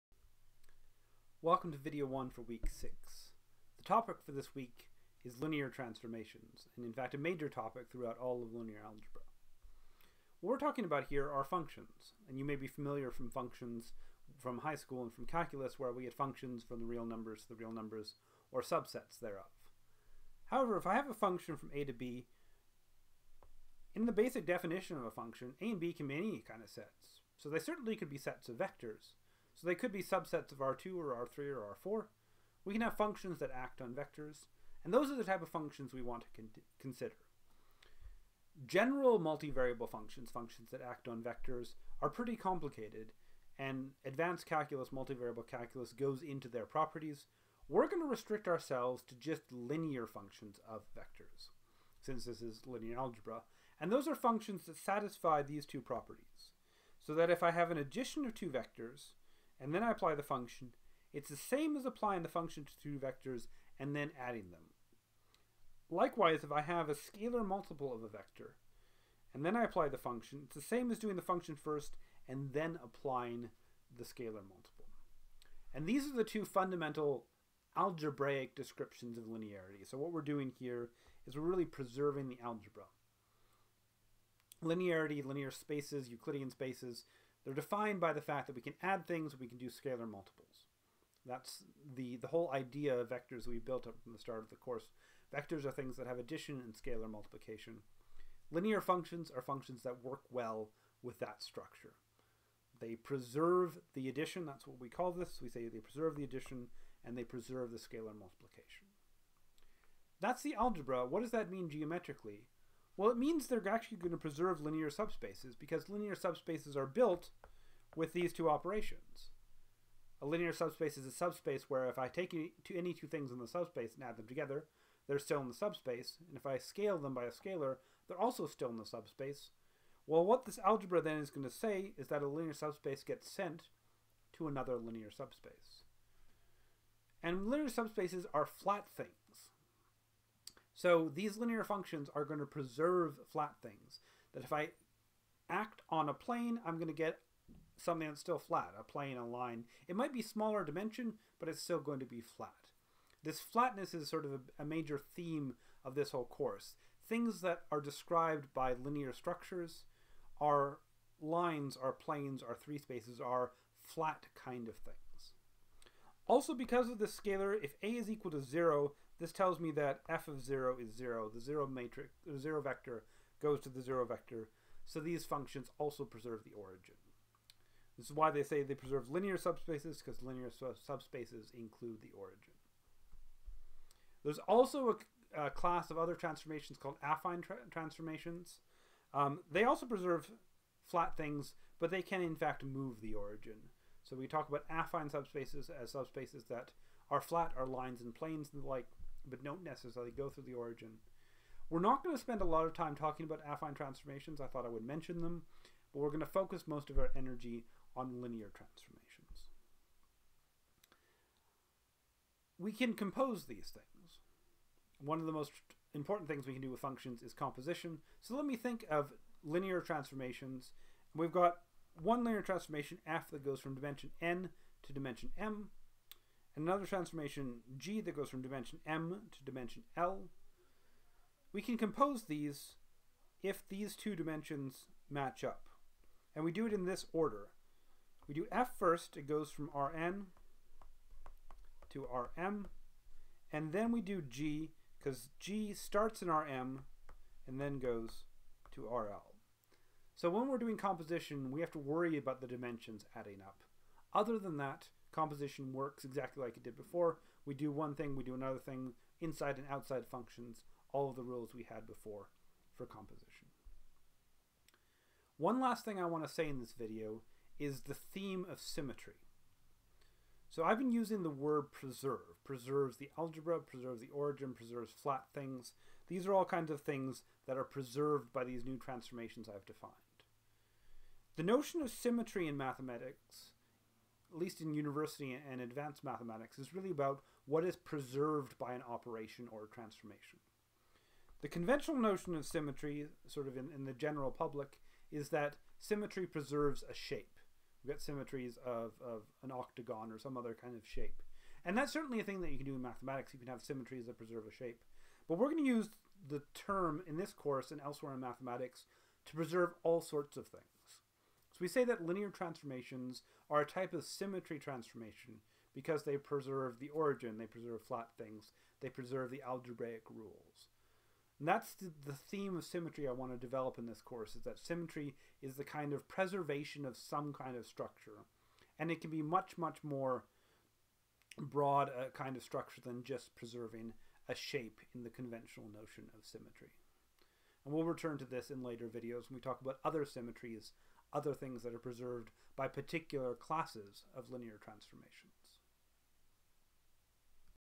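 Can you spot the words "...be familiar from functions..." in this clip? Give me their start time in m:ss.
0:12.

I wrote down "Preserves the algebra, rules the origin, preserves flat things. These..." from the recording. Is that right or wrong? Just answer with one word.
wrong.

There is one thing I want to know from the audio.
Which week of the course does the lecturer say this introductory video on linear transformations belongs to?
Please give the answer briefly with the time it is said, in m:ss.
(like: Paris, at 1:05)
Week 6, at 0:02.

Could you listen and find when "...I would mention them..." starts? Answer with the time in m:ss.
3:24.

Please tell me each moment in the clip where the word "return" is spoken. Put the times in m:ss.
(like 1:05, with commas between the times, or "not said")
5:37.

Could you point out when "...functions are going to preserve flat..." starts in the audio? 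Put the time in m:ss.
2:21.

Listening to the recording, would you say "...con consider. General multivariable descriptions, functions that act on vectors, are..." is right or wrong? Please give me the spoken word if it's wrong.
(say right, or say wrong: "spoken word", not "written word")
wrong: "functions", not "descriptions".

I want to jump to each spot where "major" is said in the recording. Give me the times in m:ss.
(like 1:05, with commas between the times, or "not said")
0:07, 2:34.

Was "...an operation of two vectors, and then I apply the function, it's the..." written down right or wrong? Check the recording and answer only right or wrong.
wrong.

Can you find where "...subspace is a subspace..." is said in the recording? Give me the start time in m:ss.
2:00.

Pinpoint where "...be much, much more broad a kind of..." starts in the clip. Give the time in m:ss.
5:29.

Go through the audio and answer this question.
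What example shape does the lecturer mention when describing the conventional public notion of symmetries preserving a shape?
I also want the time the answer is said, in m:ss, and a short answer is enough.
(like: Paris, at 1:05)
an octagon, at 4:59.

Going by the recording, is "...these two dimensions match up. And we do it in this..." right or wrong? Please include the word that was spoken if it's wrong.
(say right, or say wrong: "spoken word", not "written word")
right.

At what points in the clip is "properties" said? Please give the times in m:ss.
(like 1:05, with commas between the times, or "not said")
0:46, 0:55.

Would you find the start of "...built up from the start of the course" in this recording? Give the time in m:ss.
1:33.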